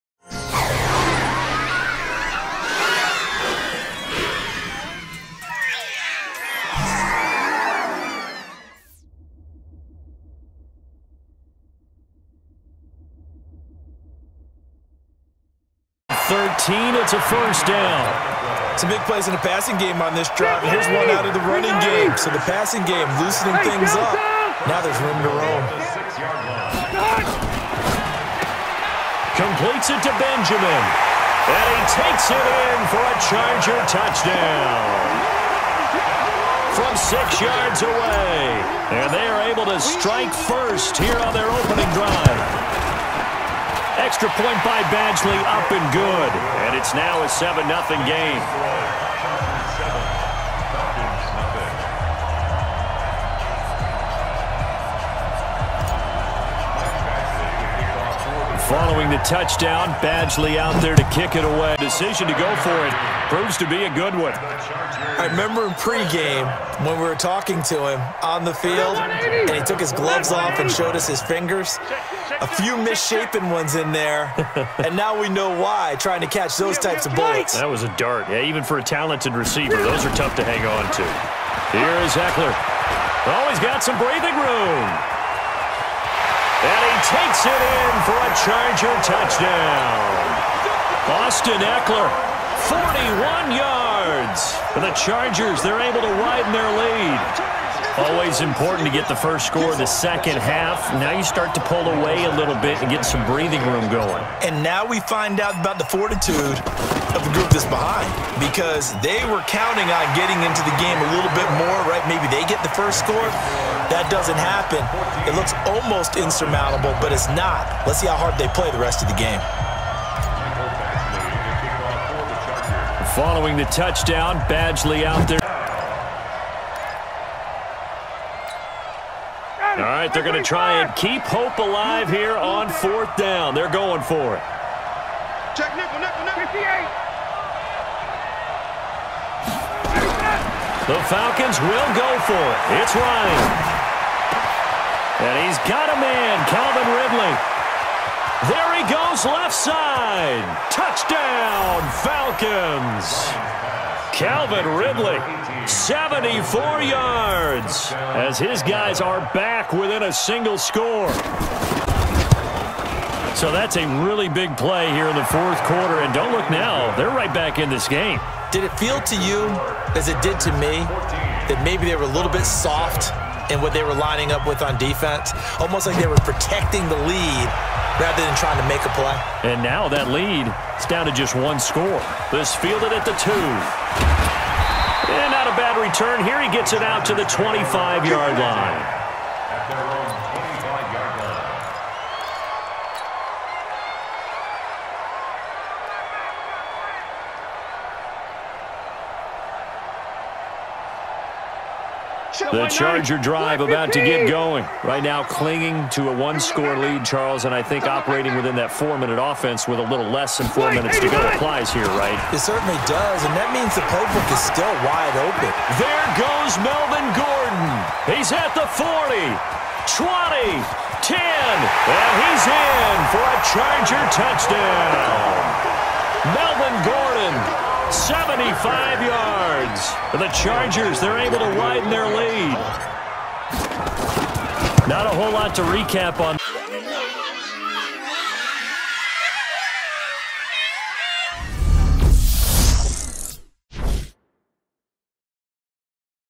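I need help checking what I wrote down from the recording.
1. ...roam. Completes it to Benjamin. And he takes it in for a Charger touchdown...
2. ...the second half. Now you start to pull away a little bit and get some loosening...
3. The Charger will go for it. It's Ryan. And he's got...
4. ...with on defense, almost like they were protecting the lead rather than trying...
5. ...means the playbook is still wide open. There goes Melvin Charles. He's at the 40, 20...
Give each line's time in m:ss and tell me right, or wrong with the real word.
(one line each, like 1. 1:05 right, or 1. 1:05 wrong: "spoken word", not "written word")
1. 0:25 right
2. 1:39 wrong: "breathing", not "loosening"
3. 2:20 wrong: "Falcons", not "Charger"
4. 2:54 right
5. 3:33 wrong: "Gordon", not "Charles".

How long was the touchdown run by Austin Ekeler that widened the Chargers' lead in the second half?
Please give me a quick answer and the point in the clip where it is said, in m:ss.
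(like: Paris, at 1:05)
41 yards, at 1:32.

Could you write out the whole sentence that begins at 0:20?
And here's one out of the running game.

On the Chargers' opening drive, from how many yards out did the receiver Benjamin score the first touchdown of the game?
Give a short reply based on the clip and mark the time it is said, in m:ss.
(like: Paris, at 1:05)
6, at 0:36.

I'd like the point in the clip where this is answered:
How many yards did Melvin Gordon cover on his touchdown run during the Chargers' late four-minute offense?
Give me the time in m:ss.
3:47.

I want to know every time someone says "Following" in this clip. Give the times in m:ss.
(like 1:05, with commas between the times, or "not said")
0:58, 2:03.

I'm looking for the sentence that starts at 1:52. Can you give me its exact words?
Maybe they get the first score.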